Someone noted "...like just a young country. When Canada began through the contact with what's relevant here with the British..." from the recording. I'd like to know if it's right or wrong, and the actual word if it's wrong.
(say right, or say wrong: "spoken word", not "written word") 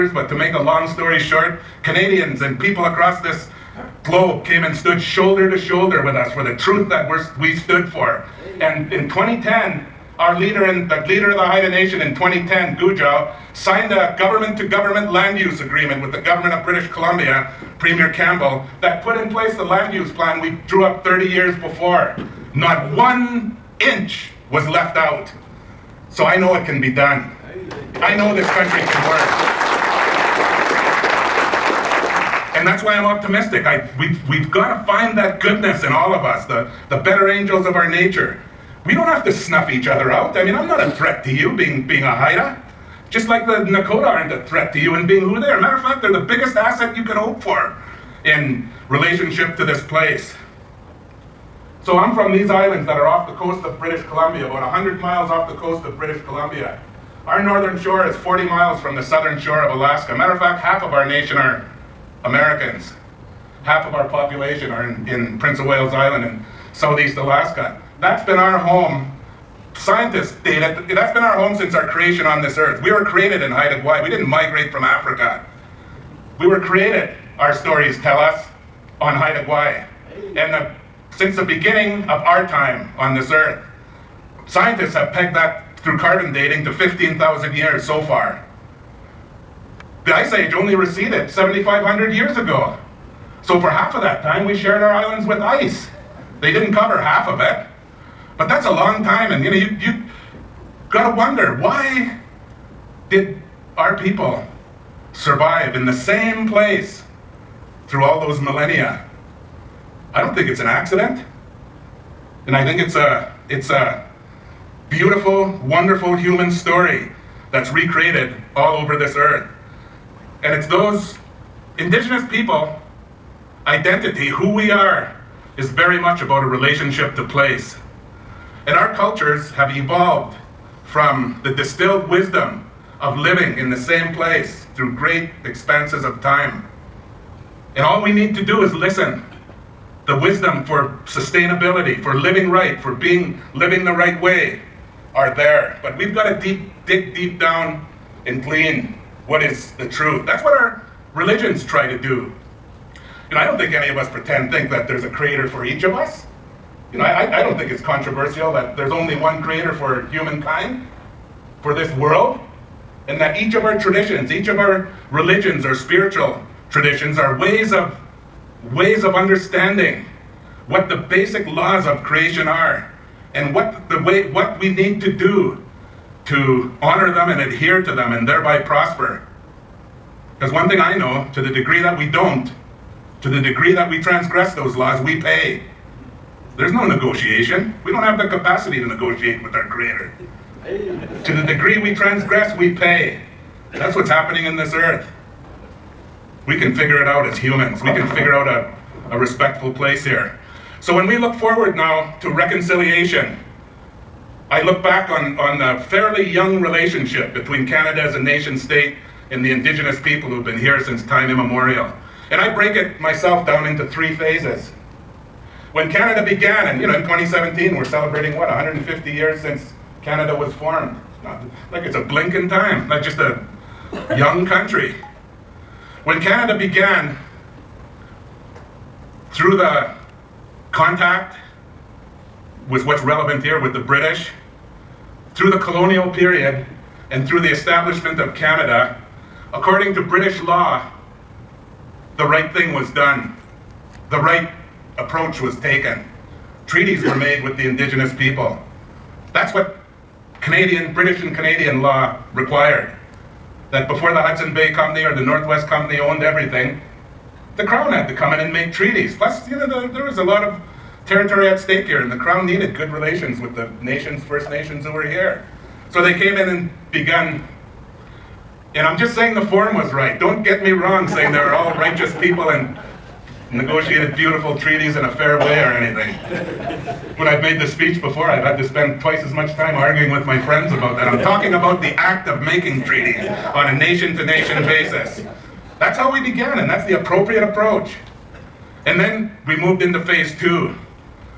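right.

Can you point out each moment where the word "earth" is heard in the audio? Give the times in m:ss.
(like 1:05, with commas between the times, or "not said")
1:12, 1:23, 1:59, 3:14.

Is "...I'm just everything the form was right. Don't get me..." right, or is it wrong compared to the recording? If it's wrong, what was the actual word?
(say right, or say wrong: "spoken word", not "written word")
wrong: "saying", not "everything".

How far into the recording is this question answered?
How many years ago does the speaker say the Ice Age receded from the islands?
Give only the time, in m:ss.
1:31.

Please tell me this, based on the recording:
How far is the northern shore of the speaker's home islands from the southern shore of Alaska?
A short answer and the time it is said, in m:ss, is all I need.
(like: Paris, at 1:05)
40 miles, at 0:58.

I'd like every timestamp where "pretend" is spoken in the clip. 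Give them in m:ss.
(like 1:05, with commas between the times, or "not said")
2:34.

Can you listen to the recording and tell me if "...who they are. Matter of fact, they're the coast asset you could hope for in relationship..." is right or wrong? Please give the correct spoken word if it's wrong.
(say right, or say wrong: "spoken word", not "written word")
wrong: "biggest", not "coast".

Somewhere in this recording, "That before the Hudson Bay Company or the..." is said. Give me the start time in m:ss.
4:13.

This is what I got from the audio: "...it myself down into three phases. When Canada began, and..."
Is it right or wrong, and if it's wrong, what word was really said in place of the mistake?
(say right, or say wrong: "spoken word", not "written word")
right.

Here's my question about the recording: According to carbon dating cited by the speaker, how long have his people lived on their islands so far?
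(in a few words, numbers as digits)
15,000 years.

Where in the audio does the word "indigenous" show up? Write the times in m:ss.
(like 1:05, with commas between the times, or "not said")
2:01, 3:29, 4:07.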